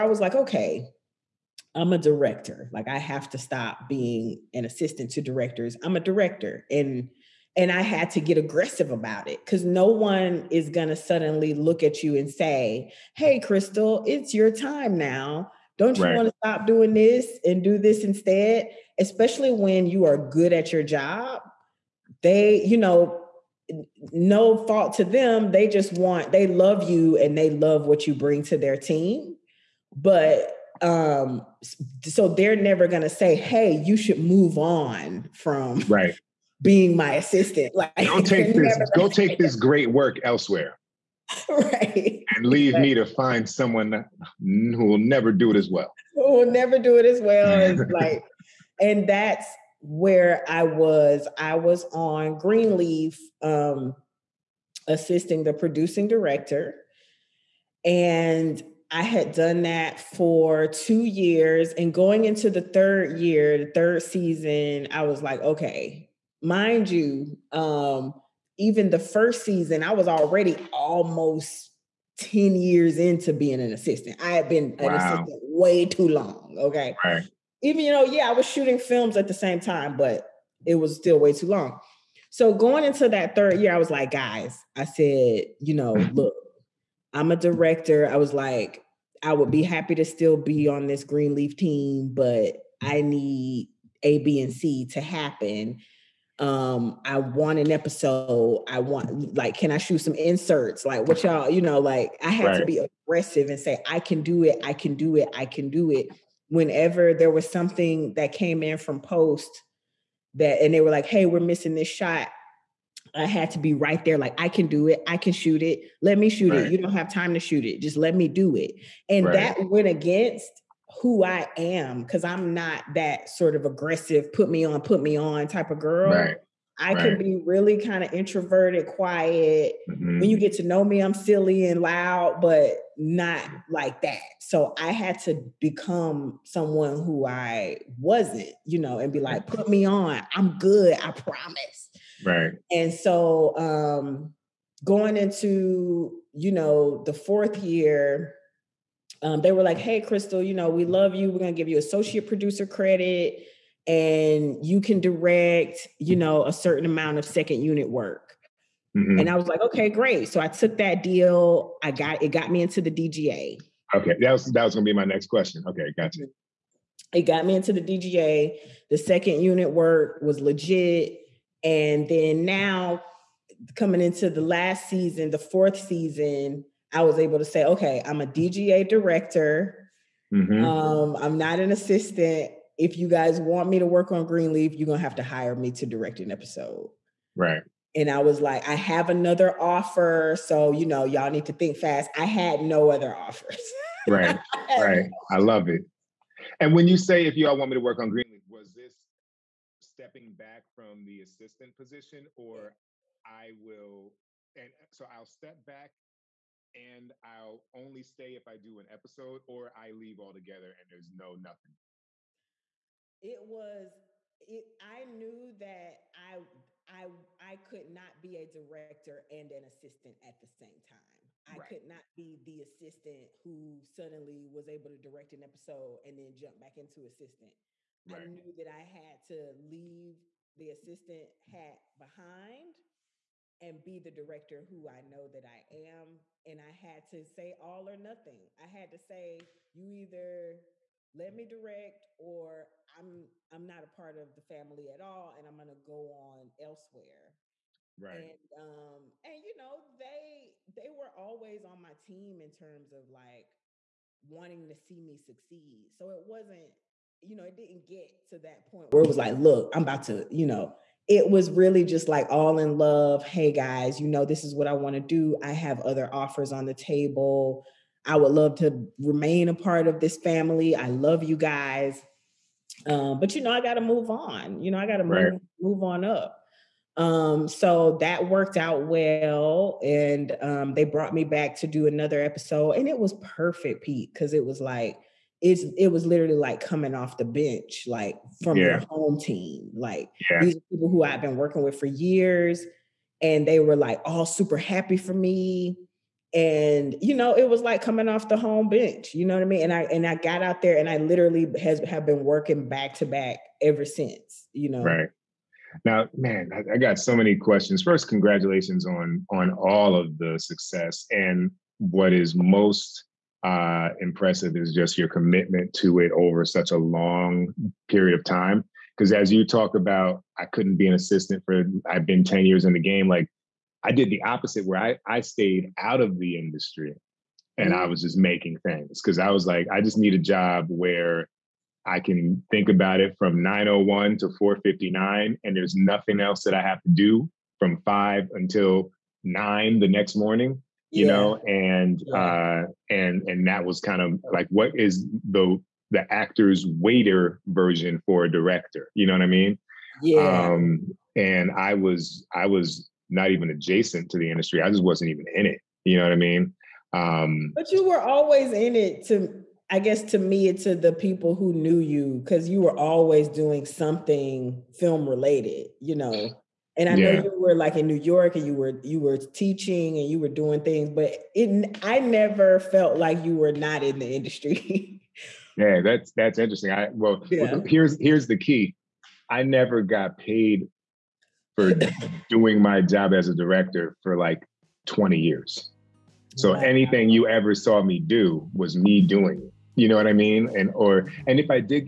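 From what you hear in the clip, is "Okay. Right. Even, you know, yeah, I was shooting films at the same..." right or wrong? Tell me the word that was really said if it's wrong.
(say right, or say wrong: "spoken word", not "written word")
right.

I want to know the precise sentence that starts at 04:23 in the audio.
Hey guys, you know, this is what I want to do.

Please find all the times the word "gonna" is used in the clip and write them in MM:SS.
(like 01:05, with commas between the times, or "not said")
02:44, 03:04, 04:05.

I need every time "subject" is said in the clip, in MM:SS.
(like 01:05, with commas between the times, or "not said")
not said.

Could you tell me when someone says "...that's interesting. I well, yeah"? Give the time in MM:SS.
06:16.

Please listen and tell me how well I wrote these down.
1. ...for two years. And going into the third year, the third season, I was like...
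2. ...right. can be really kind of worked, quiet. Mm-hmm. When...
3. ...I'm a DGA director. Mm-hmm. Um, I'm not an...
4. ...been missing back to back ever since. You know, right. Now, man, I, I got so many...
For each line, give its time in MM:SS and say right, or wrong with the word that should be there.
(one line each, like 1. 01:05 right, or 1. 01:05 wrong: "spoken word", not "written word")
1. 00:59 right
2. 02:06 wrong: "introverted", not "worked"
3. 02:58 right
4. 05:02 wrong: "working", not "missing".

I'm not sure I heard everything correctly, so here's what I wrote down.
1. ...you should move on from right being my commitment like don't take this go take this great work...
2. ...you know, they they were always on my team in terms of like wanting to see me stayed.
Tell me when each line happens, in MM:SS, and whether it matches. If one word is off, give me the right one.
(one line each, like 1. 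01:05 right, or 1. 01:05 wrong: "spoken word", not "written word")
1. 00:33 wrong: "assistant", not "commitment"
2. 04:09 wrong: "succeed", not "stayed".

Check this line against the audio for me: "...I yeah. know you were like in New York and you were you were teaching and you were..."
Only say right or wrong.
right.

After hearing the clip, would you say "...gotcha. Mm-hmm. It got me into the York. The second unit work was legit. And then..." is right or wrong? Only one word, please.
wrong.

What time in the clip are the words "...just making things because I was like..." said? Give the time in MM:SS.
05:28.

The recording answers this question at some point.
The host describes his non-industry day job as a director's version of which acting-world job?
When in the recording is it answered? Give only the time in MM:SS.
05:46.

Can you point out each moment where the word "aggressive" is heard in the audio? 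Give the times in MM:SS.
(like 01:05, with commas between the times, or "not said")
00:08, 01:43, 02:03.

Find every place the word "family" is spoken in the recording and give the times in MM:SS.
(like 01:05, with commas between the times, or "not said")
04:04, 04:30.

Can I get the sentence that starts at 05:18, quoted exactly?
Because as you talk about, I couldn't be an assistant for, I've been 10 years in the game.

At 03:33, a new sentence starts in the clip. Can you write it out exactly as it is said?
It was it I knew that I I I could not be a director and an assistant at the same time.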